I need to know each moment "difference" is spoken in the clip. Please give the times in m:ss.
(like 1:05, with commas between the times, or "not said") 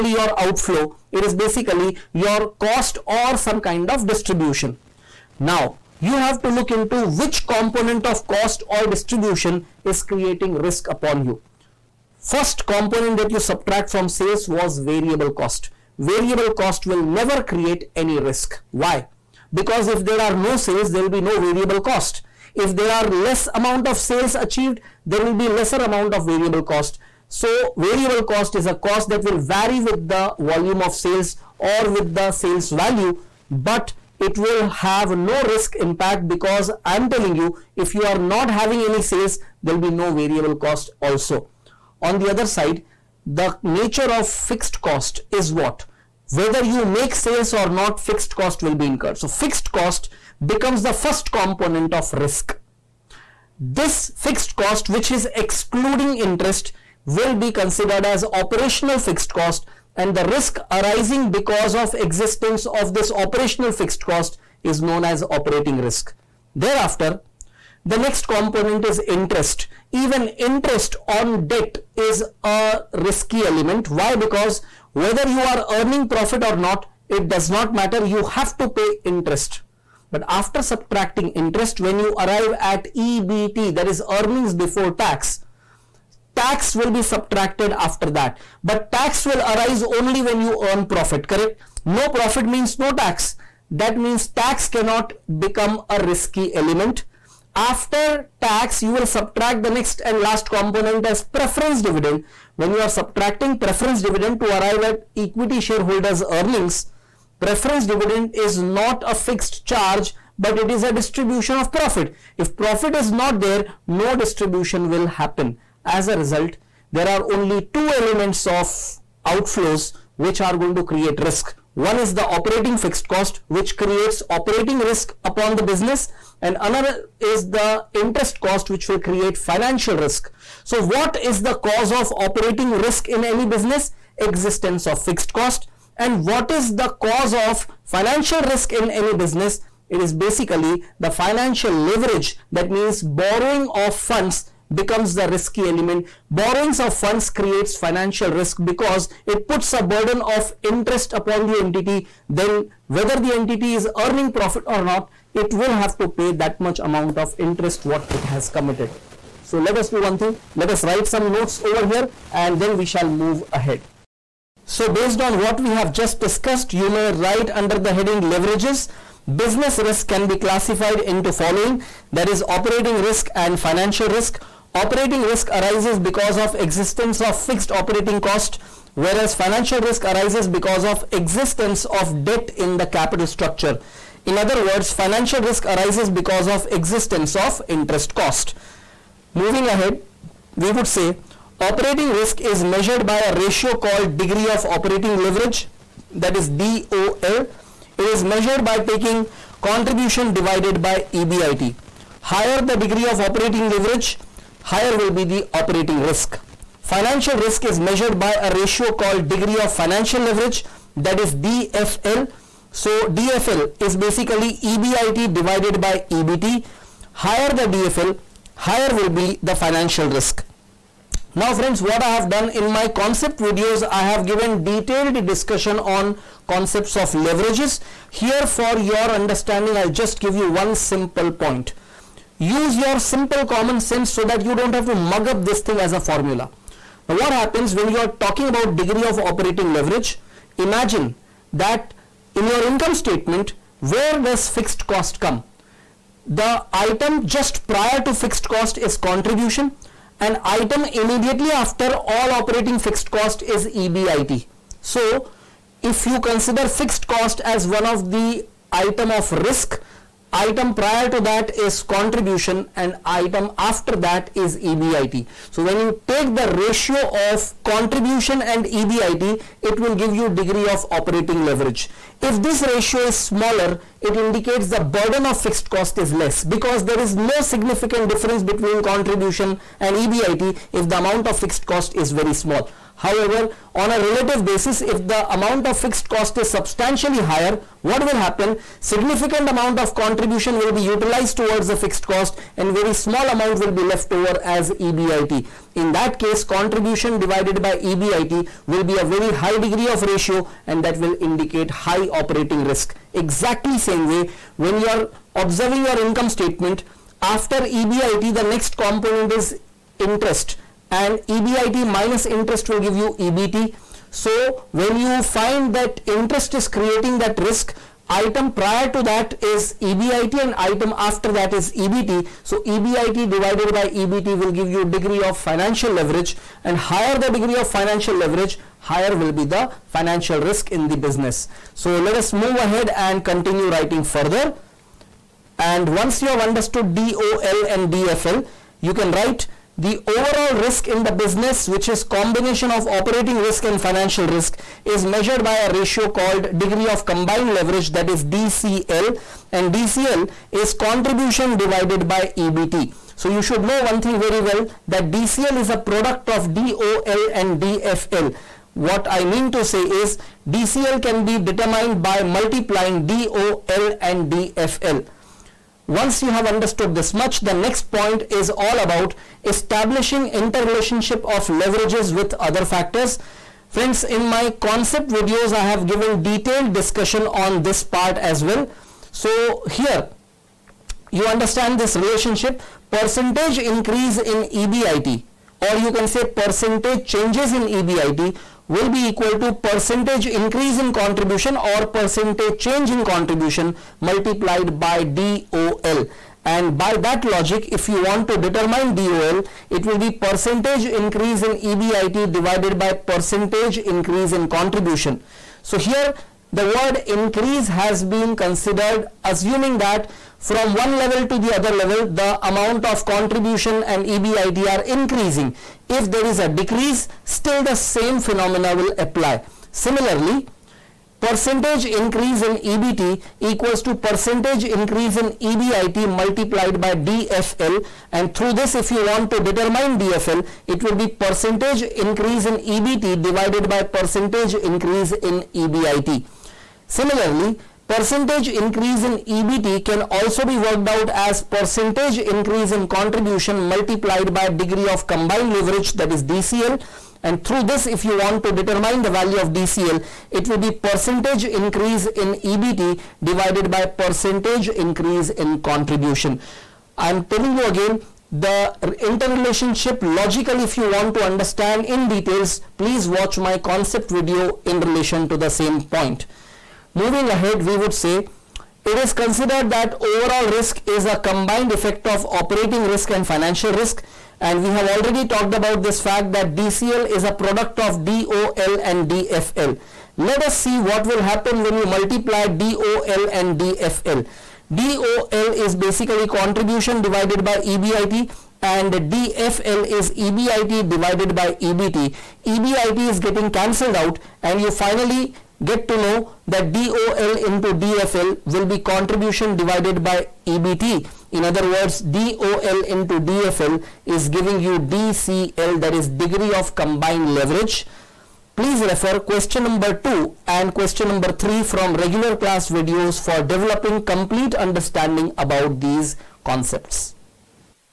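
4:38.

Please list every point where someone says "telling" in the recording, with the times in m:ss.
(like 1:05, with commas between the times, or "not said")
0:37, 7:37.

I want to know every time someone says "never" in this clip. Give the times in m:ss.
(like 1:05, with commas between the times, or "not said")
0:17.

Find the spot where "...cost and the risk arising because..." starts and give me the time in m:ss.
0:59.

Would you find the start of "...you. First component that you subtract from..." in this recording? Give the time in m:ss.
0:11.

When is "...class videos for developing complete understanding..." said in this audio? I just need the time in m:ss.
8:32.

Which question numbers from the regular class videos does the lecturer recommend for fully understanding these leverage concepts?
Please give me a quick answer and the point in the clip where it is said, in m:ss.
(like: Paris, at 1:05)
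2 and 3, at 8:29.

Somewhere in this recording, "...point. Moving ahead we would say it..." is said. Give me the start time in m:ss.
7:45.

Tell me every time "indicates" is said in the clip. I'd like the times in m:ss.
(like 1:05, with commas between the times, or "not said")
4:34, 5:01.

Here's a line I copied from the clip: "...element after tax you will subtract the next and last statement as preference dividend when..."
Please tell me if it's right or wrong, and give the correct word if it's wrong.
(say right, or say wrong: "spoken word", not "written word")
wrong: "component", not "statement".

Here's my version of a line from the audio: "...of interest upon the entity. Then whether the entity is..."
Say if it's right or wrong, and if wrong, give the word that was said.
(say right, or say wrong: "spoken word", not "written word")
right.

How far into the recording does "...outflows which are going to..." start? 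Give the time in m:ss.
1:59.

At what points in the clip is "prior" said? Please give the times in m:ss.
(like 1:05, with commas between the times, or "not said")
4:07, 4:20, 5:18.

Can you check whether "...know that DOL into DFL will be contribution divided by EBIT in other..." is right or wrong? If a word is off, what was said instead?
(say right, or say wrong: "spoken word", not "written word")
wrong: "EBT", not "EBIT".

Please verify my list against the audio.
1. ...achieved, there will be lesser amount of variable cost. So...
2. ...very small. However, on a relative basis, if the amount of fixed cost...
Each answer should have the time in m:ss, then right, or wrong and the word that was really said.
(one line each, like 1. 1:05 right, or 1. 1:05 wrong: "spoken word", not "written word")
1. 0:24 right
2. 4:42 right.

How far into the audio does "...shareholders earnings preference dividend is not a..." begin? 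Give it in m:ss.
1:45.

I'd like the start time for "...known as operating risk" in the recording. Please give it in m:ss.
1:04.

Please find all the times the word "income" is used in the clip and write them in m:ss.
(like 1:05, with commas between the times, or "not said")
4:02, 5:05.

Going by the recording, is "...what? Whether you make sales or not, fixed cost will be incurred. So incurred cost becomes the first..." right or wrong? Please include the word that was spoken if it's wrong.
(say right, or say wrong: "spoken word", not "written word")
wrong: "fixed", not "incurred".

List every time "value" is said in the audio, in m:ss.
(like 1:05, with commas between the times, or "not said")
0:32, 7:29.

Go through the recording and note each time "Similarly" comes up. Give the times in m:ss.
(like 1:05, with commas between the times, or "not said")
6:59, 7:16.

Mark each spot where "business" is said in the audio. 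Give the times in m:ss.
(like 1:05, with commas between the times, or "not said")
2:05, 2:13, 2:19, 2:49, 5:30, 5:41.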